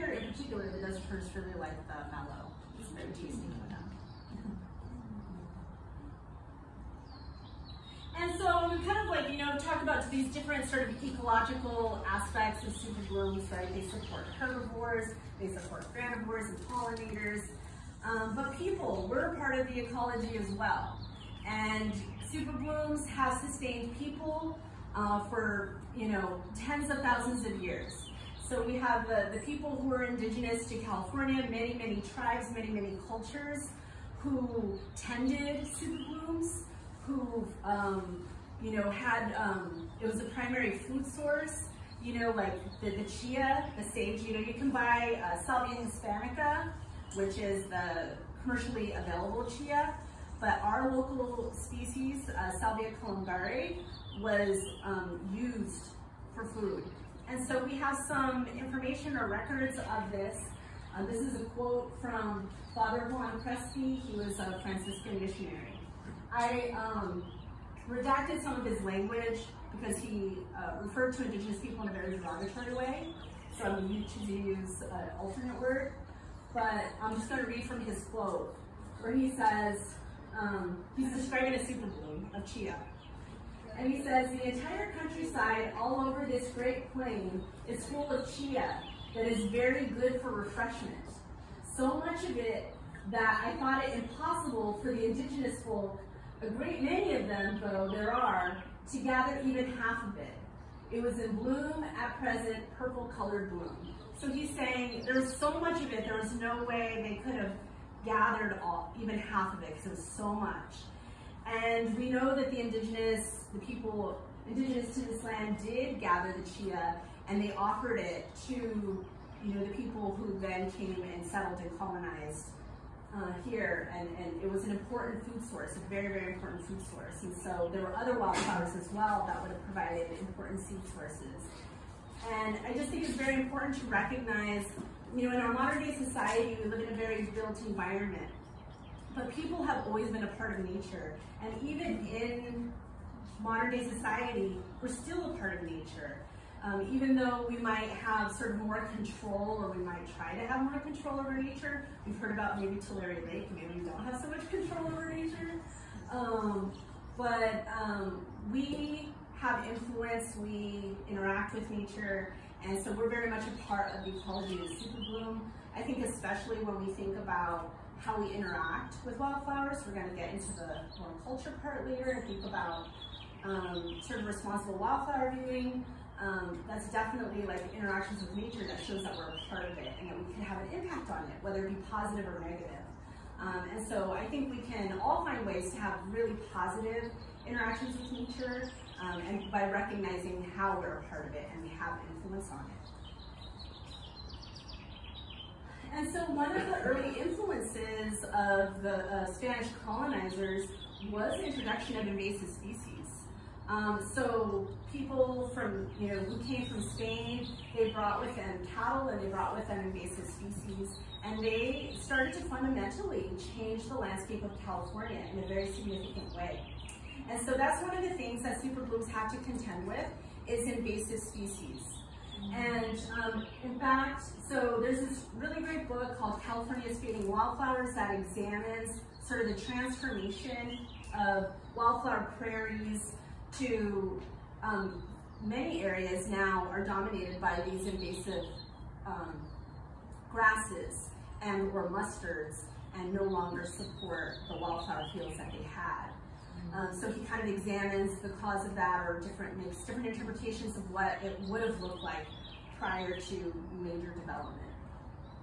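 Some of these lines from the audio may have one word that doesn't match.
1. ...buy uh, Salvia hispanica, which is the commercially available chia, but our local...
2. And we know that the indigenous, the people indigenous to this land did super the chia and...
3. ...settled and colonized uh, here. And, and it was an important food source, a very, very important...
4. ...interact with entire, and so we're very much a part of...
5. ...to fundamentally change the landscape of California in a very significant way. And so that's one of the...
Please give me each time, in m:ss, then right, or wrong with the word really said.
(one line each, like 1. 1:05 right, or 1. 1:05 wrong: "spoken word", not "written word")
1. 0:44 right
2. 1:51 wrong: "gather", not "super"
3. 2:01 right
4. 2:41 wrong: "nature", not "entire"
5. 3:32 right.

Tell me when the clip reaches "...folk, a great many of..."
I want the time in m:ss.
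1:35.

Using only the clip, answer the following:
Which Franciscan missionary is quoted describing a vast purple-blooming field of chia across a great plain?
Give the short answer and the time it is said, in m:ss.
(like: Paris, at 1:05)
Juan Crespi, at 1:02.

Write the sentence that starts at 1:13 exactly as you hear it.
So I'm going to use an uh, alternate word.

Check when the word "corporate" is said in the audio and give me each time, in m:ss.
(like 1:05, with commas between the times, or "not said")
not said.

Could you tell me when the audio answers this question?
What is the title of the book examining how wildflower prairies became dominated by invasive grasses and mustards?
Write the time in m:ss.
3:46.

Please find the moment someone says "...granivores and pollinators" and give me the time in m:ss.
0:15.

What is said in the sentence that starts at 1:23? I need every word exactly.
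And he says, the entire countryside all over this great plain is full of chia that is very good for refreshment.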